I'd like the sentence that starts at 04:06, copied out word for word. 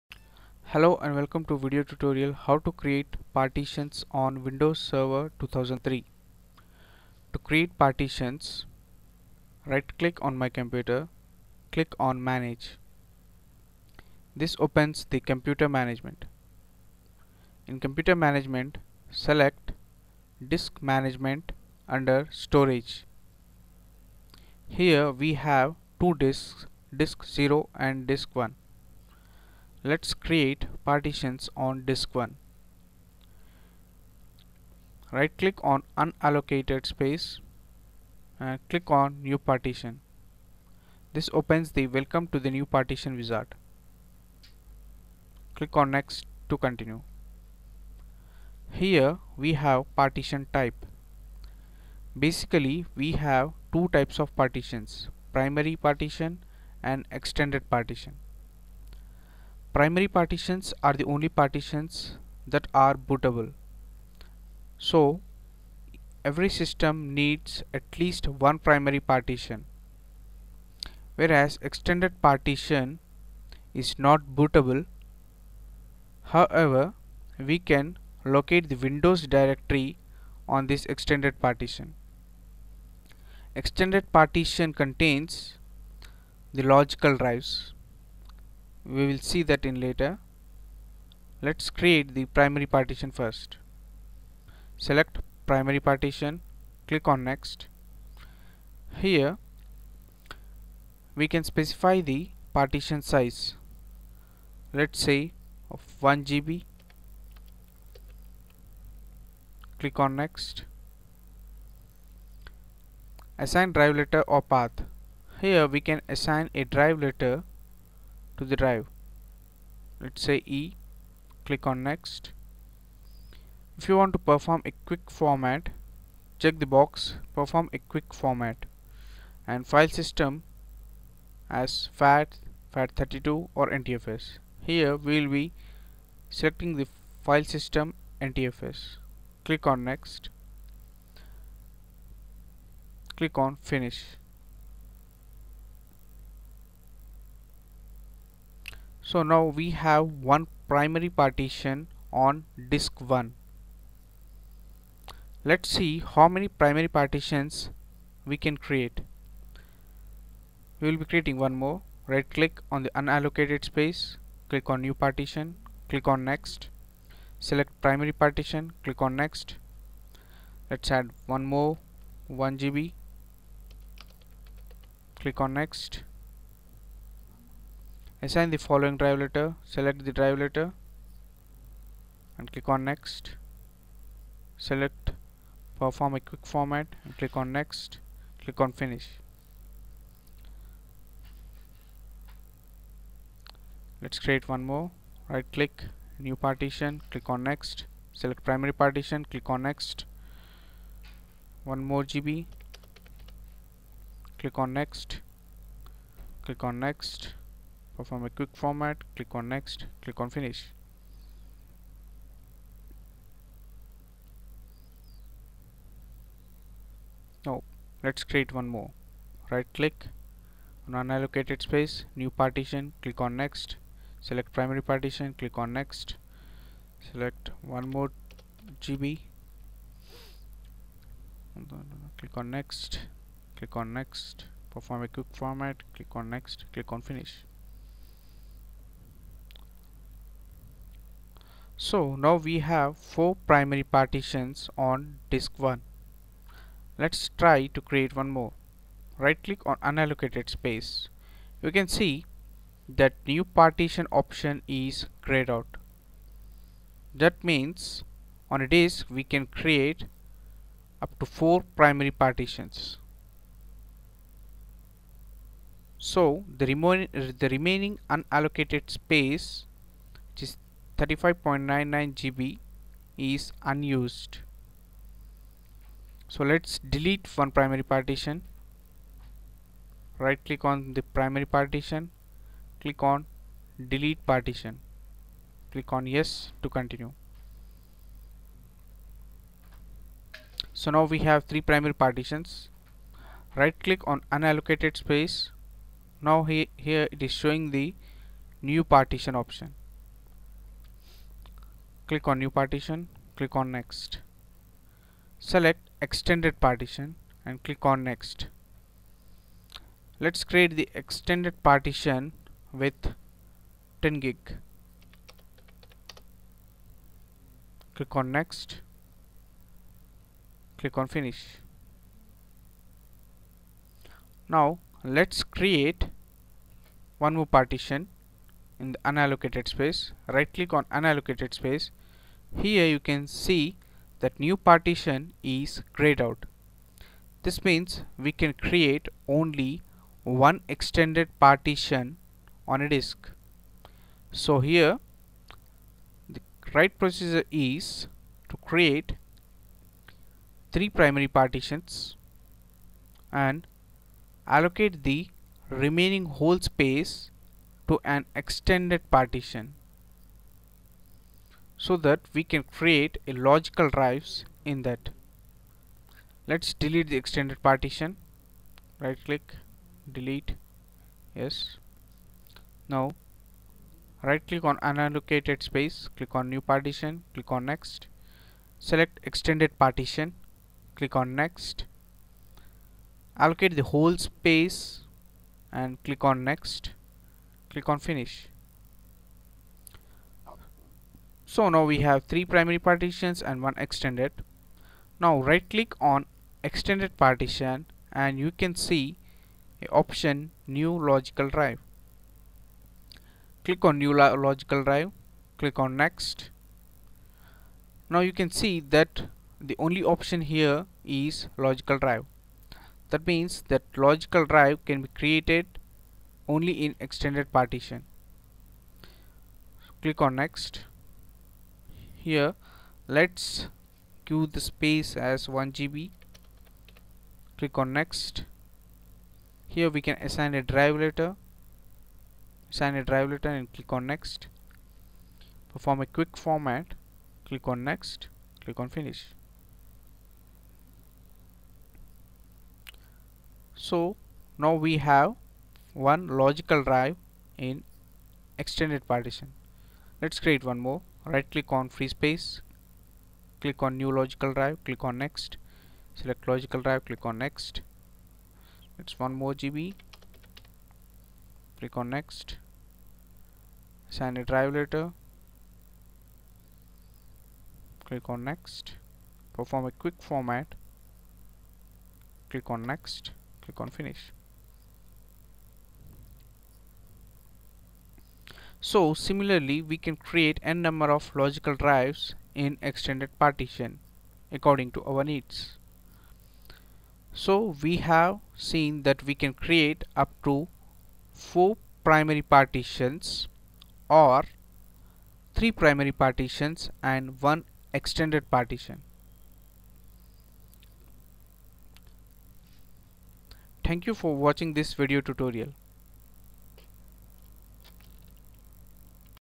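Let's try to create one more.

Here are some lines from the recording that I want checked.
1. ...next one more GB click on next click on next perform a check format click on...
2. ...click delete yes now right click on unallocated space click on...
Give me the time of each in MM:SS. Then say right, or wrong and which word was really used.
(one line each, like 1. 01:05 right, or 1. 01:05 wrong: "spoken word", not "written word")
1. 03:19 wrong: "quick", not "check"
2. 06:09 right.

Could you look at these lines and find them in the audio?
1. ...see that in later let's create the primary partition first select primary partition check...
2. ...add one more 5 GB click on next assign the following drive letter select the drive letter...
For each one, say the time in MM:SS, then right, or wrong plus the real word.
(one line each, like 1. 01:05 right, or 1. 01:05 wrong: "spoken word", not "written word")
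1. 01:29 wrong: "click", not "check"
2. 02:51 wrong: "1", not "5".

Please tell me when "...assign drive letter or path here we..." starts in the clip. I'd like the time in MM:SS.
01:53.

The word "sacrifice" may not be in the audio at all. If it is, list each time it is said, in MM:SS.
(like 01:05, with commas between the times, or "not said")
not said.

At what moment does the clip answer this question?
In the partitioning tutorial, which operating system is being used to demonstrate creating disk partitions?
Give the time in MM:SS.
00:04.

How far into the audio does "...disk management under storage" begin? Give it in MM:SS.
00:20.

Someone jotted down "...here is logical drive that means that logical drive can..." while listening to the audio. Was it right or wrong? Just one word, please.
right.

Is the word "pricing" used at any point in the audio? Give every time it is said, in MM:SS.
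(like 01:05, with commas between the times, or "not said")
not said.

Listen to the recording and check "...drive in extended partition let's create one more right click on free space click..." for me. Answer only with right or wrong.
right.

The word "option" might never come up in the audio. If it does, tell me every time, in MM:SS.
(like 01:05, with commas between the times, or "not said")
04:14, 04:59, 06:40, 06:50.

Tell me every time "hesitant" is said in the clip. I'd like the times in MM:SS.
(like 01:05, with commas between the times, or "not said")
not said.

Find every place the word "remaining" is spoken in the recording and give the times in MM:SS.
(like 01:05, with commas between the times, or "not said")
04:27, 05:55.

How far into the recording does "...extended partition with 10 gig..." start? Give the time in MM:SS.
05:10.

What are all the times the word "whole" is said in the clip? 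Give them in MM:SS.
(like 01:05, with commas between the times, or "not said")
05:56, 06:23.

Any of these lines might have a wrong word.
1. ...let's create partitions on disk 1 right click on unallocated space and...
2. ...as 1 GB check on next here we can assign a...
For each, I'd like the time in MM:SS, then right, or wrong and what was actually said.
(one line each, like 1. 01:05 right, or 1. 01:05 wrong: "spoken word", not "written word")
1. 00:29 right
2. 07:05 wrong: "click", not "check".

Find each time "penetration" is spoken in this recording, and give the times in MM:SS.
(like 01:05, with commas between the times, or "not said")
not said.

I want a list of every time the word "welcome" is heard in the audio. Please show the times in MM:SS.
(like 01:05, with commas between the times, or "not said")
00:01, 00:41.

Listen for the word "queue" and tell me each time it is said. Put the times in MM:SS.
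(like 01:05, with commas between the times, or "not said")
07:04.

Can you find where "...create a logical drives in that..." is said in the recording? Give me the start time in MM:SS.
06:02.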